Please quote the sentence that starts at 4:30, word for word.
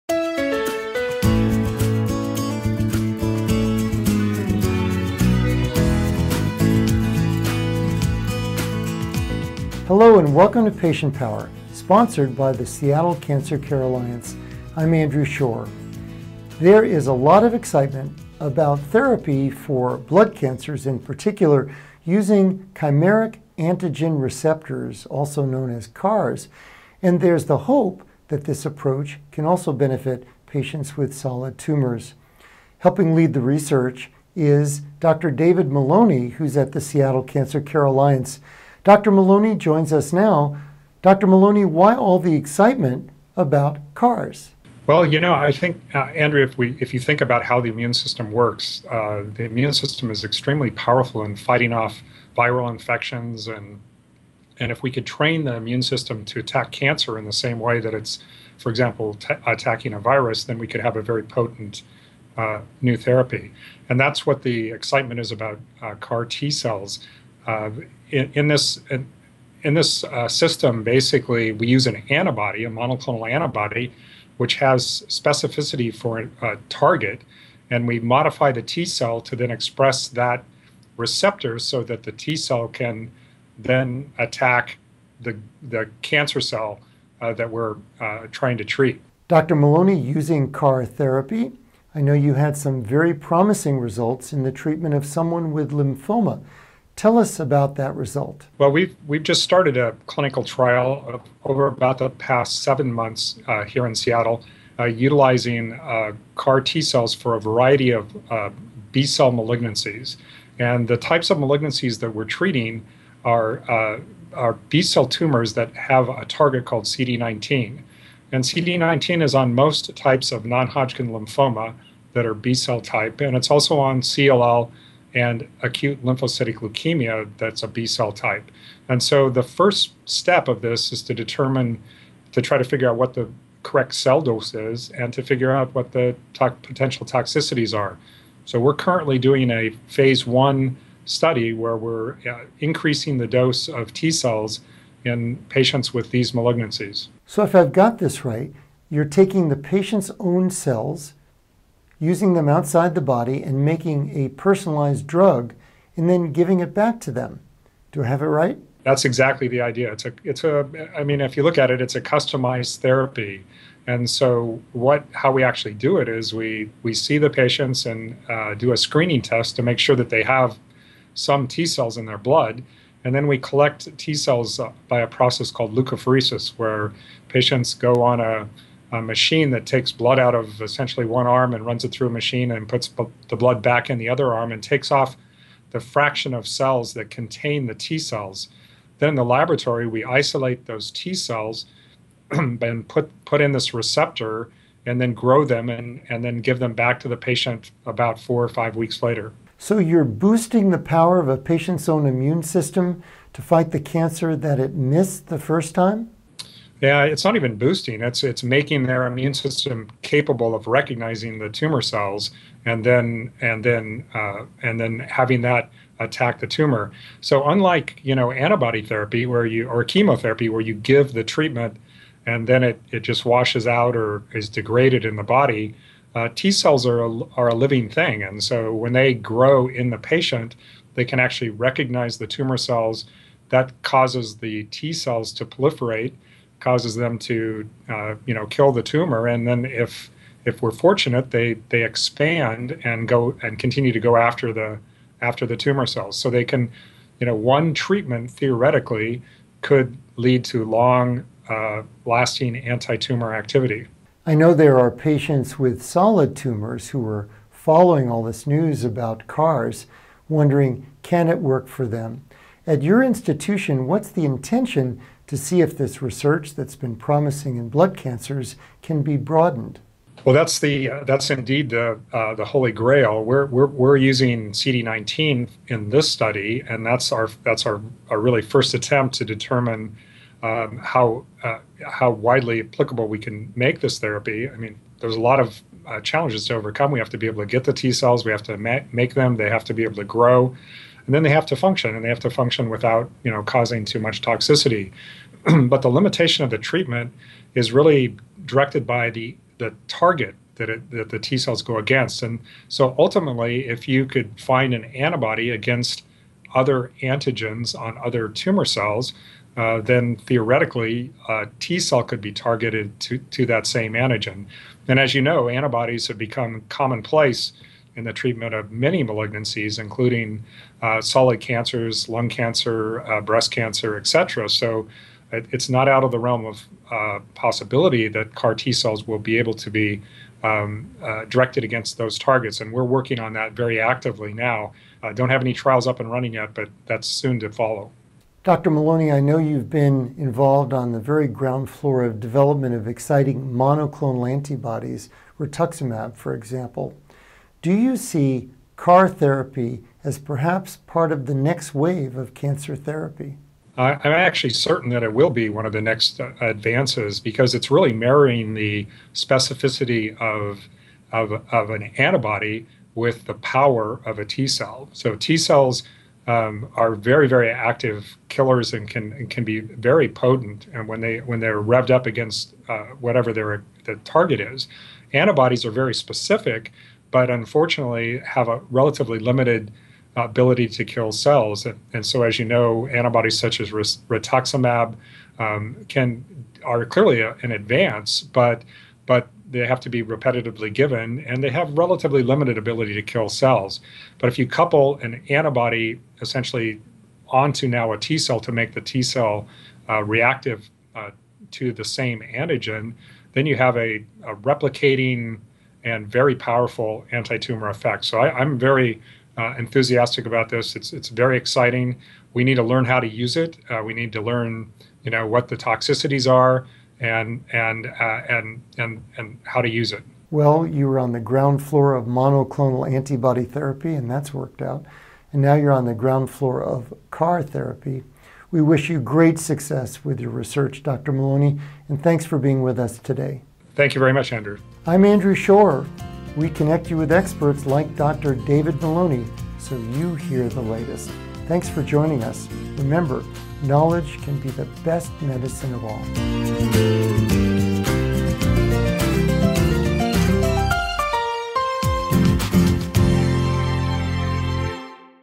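Well, that's the uh, that's indeed the uh, the holy grail.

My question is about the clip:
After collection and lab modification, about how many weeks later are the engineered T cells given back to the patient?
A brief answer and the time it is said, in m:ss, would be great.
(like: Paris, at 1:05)
4 or 5 weeks, at 3:18.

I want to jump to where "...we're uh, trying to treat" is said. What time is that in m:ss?
1:27.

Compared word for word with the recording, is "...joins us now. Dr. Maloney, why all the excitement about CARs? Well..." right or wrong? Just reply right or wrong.
right.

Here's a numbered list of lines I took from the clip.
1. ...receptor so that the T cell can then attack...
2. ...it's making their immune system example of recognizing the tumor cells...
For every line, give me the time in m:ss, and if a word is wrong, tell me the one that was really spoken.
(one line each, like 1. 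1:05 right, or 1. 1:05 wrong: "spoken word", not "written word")
1. 1:20 right
2. 3:28 wrong: "capable", not "example".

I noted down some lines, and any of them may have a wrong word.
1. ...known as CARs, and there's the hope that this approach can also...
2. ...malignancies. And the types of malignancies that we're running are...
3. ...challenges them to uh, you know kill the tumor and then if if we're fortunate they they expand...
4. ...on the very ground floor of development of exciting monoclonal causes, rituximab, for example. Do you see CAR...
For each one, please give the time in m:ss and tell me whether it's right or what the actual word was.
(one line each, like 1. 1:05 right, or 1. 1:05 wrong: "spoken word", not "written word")
1. 0:25 right
2. 1:49 wrong: "treating", not "running"
3. 3:56 wrong: "causes", not "challenges"
4. 5:40 wrong: "antibodies", not "causes".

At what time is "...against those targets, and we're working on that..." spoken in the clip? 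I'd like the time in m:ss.
5:31.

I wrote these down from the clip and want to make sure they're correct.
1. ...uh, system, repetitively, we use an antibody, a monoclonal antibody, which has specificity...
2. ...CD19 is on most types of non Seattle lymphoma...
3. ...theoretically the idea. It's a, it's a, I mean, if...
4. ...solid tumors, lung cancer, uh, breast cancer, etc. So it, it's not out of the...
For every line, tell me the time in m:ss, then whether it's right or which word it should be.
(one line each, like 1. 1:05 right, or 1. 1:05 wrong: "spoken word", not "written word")
1. 1:10 wrong: "basically", not "repetitively"
2. 1:58 wrong: "Hodgkin", not "Seattle"
3. 2:39 wrong: "exactly", not "theoretically"
4. 5:21 wrong: "cancers", not "tumors".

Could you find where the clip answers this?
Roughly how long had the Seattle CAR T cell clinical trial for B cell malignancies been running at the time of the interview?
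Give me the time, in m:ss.
1:42.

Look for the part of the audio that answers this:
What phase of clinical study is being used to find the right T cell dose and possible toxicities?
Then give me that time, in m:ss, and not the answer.
2:19.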